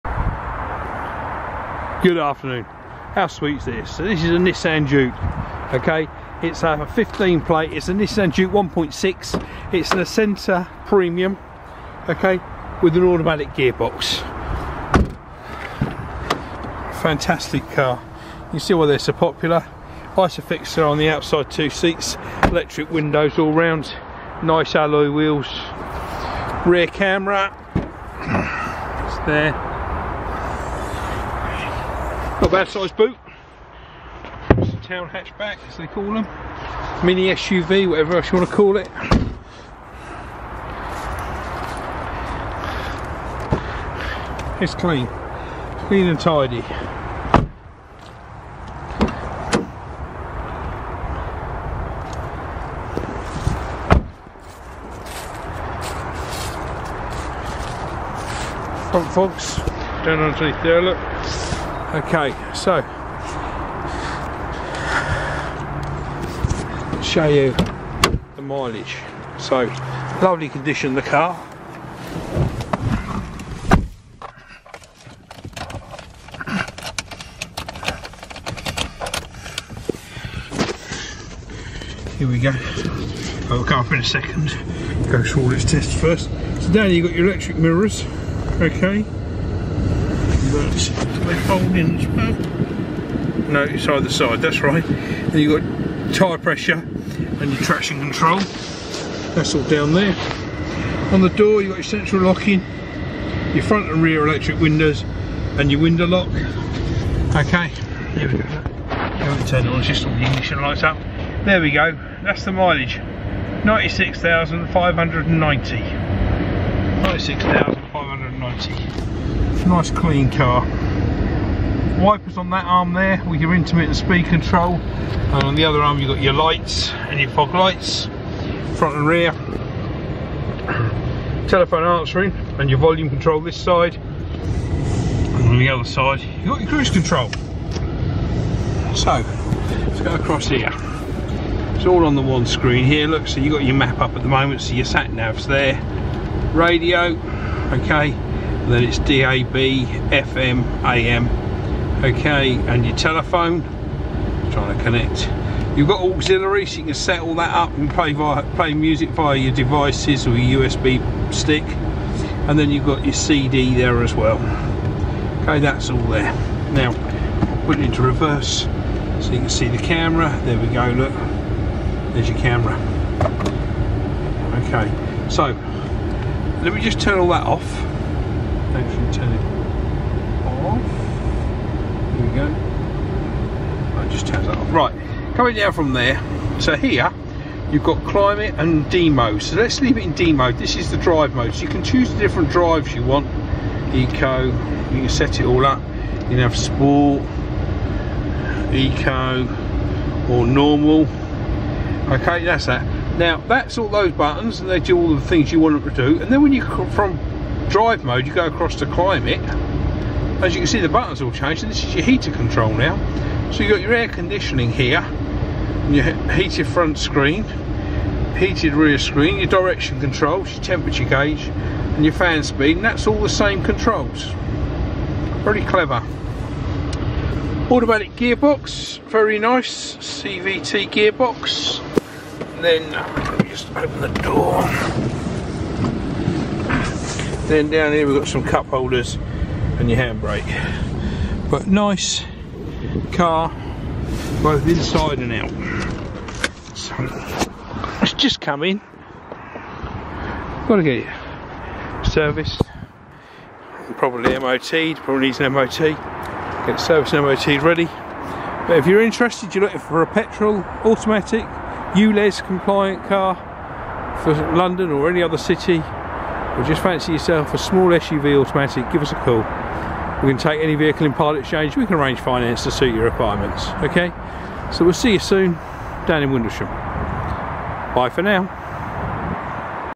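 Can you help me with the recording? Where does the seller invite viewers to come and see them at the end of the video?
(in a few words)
Windlesham.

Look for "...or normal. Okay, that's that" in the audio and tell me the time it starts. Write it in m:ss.
3:20.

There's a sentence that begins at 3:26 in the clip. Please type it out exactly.
And then when you come from drive mode, you go across to climate.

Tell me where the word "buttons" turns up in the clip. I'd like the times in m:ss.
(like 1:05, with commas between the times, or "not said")
3:24, 3:30.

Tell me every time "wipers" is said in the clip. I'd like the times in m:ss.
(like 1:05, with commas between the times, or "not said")
2:01.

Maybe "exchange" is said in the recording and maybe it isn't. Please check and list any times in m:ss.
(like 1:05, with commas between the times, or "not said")
4:31.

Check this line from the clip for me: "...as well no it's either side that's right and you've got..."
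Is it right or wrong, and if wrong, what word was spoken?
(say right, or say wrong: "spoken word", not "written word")
right.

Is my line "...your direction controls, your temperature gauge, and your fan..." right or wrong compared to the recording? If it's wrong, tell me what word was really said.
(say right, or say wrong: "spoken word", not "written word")
right.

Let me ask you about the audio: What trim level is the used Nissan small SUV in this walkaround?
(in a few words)
Acenta Premium.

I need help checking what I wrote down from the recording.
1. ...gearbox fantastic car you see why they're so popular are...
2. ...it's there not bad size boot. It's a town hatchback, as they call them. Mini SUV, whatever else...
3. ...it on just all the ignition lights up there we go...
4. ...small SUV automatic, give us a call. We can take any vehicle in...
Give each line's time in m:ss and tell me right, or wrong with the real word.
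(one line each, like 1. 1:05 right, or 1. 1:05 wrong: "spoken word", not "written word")
1. 0:13 right
2. 0:29 right
3. 1:49 right
4. 4:27 right.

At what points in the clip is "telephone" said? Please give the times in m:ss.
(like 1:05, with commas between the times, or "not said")
2:11, 2:32.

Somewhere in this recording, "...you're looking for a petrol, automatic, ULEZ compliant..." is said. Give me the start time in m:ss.
4:19.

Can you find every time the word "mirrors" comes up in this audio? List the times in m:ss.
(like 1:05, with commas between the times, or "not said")
1:27.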